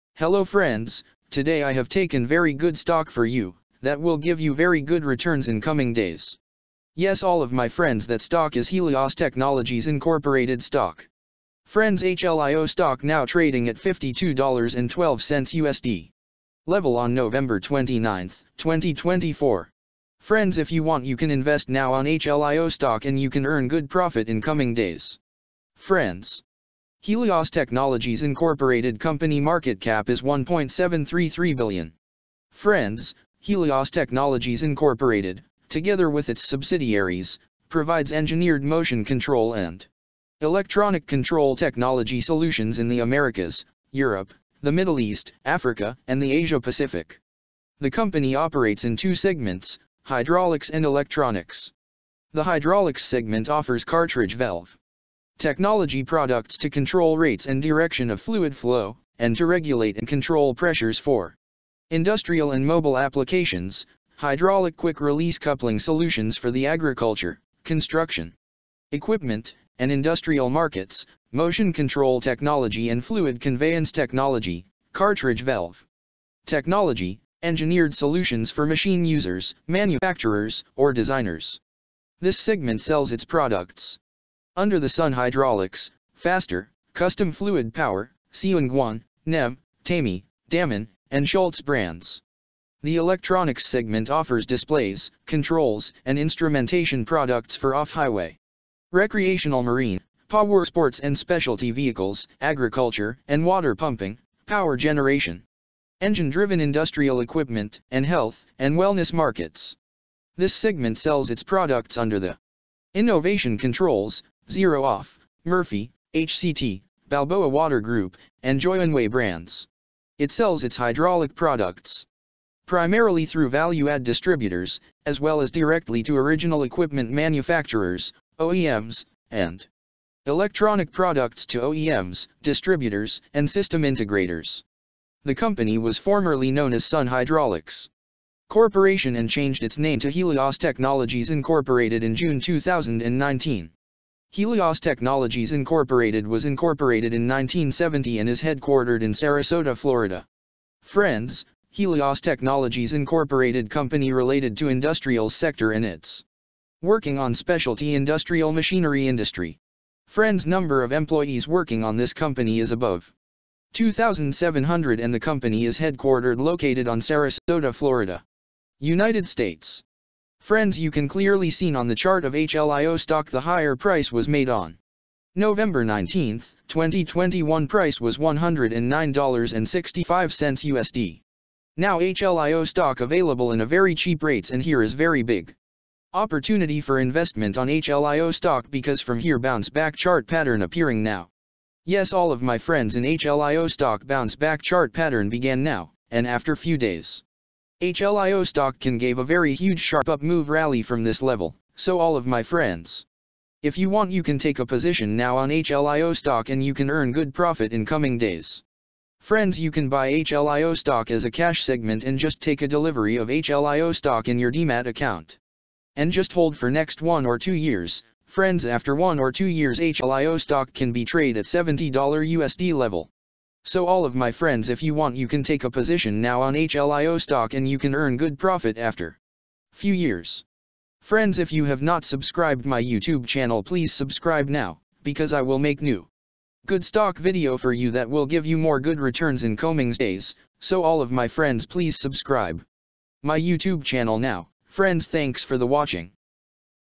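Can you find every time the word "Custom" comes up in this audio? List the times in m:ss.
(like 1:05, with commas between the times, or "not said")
1:26.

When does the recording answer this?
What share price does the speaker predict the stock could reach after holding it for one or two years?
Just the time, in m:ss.
3:41.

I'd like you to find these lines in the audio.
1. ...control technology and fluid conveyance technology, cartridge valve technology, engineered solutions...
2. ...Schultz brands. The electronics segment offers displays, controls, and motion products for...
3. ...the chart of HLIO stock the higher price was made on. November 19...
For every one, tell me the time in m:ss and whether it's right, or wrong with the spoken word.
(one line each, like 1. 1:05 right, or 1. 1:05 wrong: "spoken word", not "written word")
1. 1:11 right
2. 1:31 wrong: "instrumentation", not "motion"
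3. 2:51 right.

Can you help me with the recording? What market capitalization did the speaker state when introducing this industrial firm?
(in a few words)
1.733 billion.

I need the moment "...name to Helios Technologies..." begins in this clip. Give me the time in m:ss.
2:19.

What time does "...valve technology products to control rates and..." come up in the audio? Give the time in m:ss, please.
0:54.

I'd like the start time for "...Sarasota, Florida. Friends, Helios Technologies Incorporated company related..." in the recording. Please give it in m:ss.
2:29.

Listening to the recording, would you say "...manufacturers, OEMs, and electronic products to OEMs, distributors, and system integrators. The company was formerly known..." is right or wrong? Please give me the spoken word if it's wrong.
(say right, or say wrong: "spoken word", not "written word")
right.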